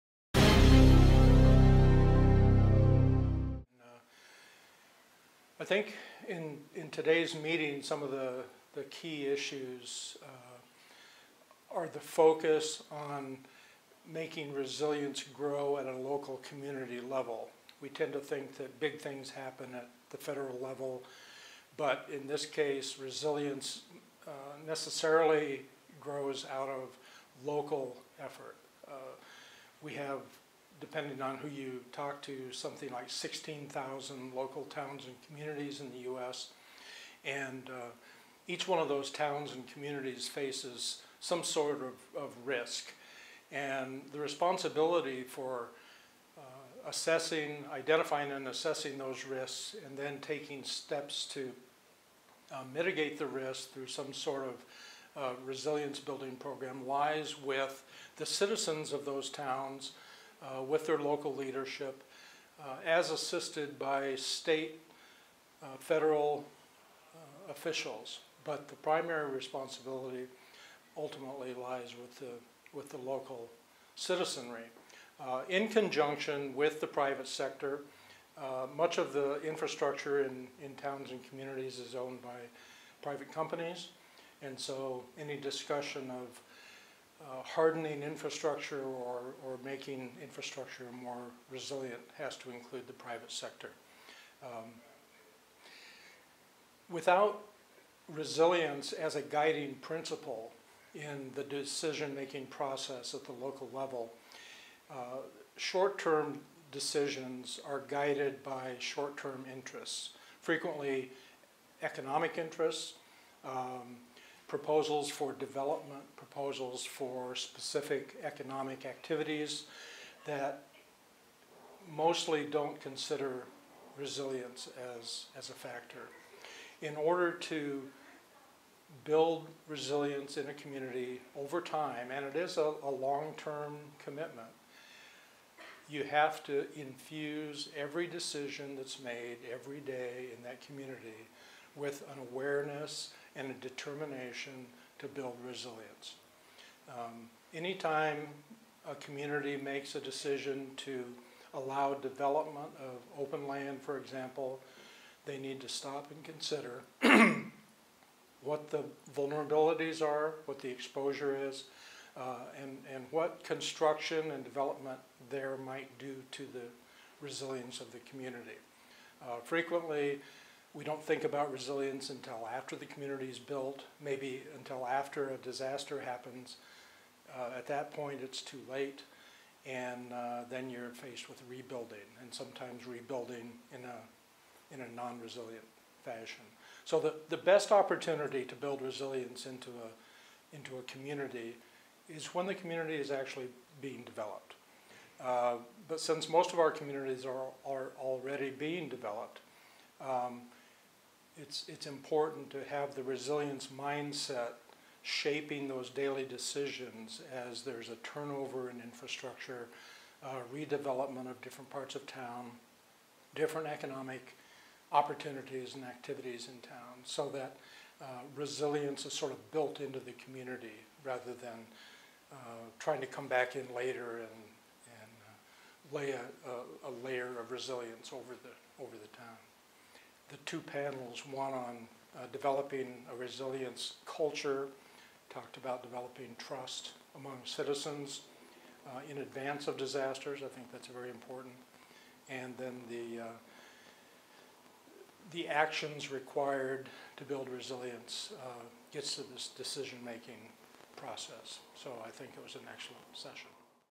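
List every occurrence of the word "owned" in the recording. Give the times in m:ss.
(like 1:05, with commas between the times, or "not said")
1:21.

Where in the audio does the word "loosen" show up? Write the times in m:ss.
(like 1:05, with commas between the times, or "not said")
not said.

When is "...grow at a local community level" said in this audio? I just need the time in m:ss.
0:15.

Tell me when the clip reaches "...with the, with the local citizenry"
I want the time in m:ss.
1:11.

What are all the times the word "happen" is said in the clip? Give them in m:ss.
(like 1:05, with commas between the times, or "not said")
0:19, 2:55.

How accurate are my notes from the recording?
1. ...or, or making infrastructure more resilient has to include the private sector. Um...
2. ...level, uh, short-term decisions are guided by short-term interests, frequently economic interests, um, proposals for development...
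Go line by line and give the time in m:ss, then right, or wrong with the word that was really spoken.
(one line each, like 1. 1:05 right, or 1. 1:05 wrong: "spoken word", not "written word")
1. 1:28 right
2. 1:43 right.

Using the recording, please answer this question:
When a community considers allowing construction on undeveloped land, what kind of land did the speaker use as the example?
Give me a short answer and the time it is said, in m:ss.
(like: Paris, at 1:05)
open land, at 2:33.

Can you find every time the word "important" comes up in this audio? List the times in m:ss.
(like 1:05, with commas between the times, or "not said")
3:21, 4:01.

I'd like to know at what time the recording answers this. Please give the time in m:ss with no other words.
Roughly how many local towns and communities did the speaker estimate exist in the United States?
0:33.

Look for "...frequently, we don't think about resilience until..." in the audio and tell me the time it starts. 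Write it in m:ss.
2:49.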